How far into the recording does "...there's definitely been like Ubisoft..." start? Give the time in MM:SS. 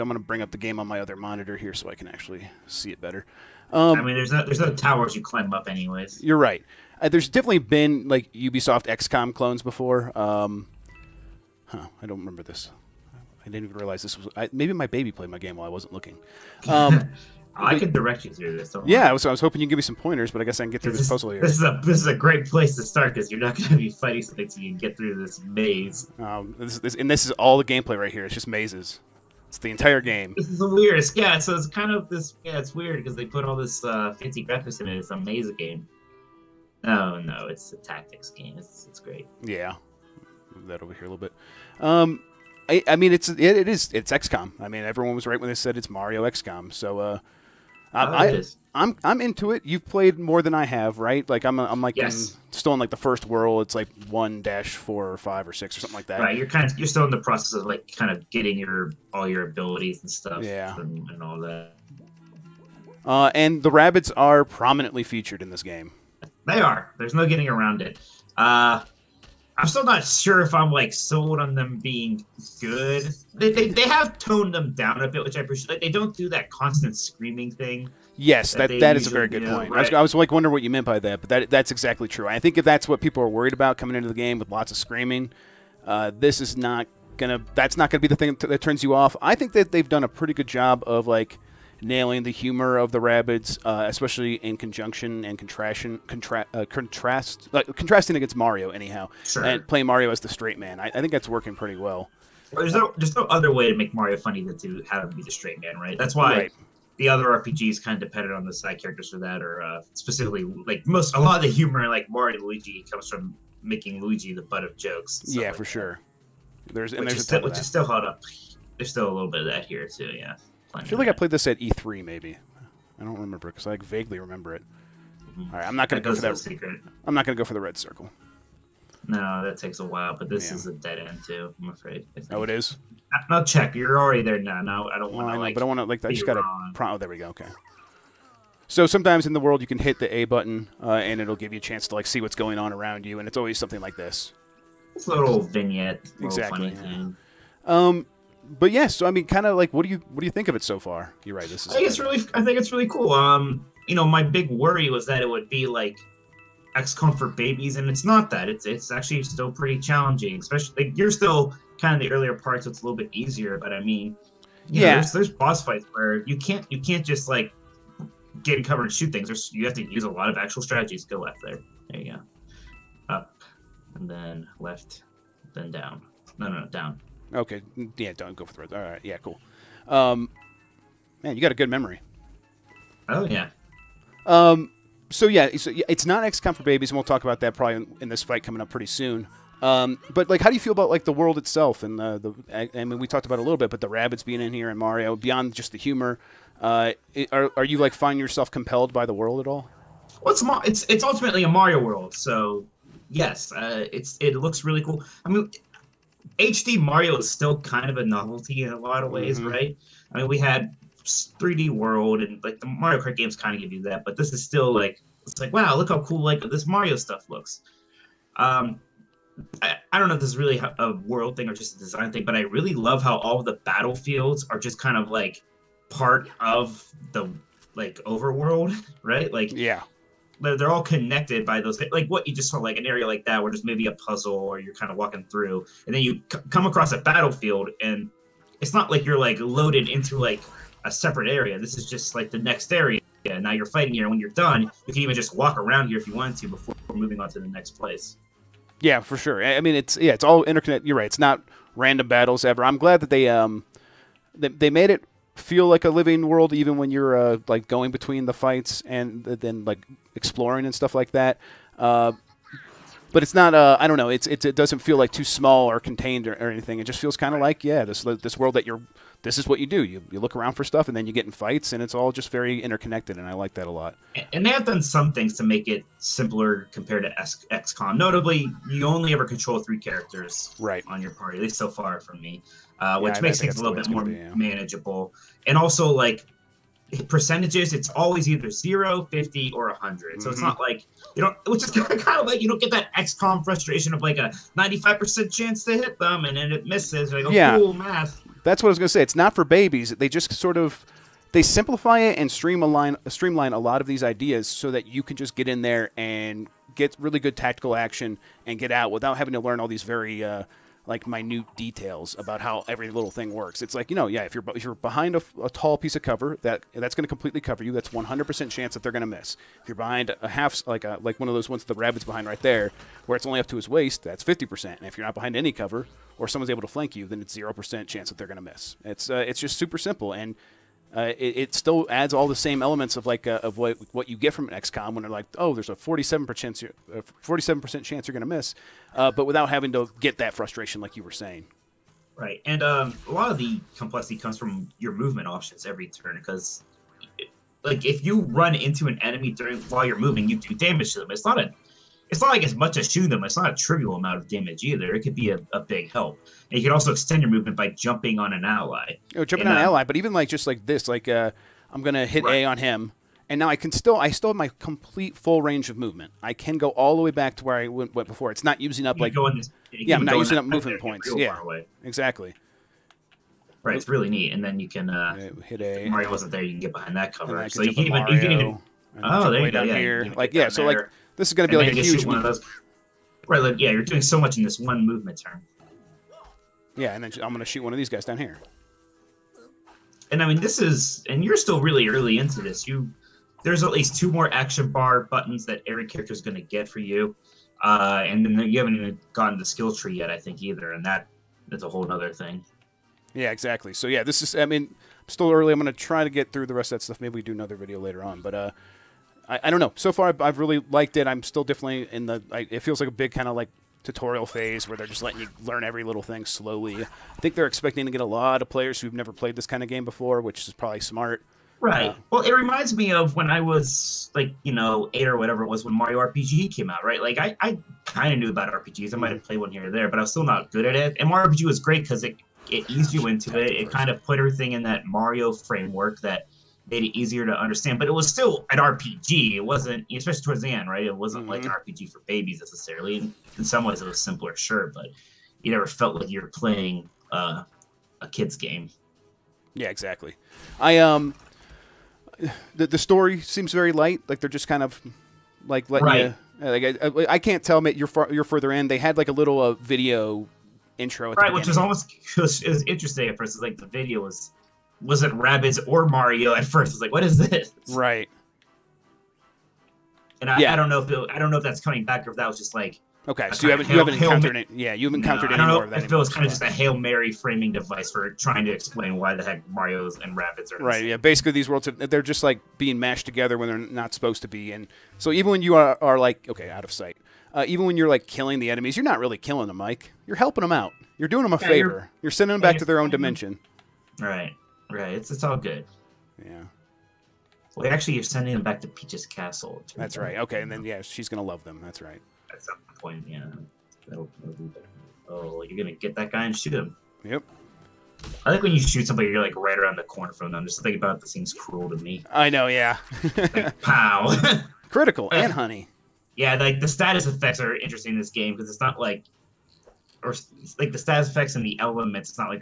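00:07.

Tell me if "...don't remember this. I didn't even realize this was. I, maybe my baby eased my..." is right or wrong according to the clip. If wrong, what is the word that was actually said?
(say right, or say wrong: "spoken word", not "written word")
wrong: "played", not "eased".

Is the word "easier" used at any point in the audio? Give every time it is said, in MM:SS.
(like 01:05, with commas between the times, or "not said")
02:43, 07:16.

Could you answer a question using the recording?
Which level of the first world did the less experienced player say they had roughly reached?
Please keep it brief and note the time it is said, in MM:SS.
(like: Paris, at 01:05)
1-4, at 00:54.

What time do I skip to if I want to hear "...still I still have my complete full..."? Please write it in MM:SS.
06:03.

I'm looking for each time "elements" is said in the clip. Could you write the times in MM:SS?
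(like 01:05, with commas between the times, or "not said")
05:32, 08:41.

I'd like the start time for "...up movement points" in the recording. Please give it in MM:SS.
06:10.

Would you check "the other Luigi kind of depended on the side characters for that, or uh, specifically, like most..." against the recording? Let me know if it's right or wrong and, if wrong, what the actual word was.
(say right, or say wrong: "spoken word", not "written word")
wrong: "RPGs", not "Luigi".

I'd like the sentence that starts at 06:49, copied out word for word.
So far, I've, I've, really liked it.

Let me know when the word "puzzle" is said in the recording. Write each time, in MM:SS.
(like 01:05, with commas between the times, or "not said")
00:21, 03:53.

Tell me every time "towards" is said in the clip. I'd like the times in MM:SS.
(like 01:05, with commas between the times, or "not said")
07:20.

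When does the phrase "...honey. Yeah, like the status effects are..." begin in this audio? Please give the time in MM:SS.
08:35.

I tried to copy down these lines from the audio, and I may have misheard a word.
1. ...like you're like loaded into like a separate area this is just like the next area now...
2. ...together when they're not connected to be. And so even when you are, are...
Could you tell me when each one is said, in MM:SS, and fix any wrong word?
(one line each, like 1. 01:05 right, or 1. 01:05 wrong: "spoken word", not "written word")
1. 03:58 right
2. 08:03 wrong: "supposed", not "connected".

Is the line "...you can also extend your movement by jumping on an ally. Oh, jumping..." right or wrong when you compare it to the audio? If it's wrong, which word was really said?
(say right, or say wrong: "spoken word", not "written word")
right.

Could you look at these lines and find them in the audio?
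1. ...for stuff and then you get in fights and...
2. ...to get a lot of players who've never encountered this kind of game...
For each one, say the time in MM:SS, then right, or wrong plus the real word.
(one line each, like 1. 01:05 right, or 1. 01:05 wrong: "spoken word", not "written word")
1. 04:30 right
2. 06:57 wrong: "played", not "encountered".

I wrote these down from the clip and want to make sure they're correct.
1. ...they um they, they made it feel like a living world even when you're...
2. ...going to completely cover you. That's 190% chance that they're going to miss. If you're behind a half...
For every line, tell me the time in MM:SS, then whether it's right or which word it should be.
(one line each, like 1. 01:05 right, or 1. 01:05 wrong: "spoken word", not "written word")
1. 04:13 right
2. 05:16 wrong: "100", not "190".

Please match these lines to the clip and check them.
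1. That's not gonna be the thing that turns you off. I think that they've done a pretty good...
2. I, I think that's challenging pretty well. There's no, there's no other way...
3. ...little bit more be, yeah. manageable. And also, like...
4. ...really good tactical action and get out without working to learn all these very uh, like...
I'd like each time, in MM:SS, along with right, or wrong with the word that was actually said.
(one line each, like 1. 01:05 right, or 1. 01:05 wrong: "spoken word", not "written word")
1. 01:27 right
2. 01:40 wrong: "working", not "challenging"
3. 04:43 right
4. 05:06 wrong: "having", not "working".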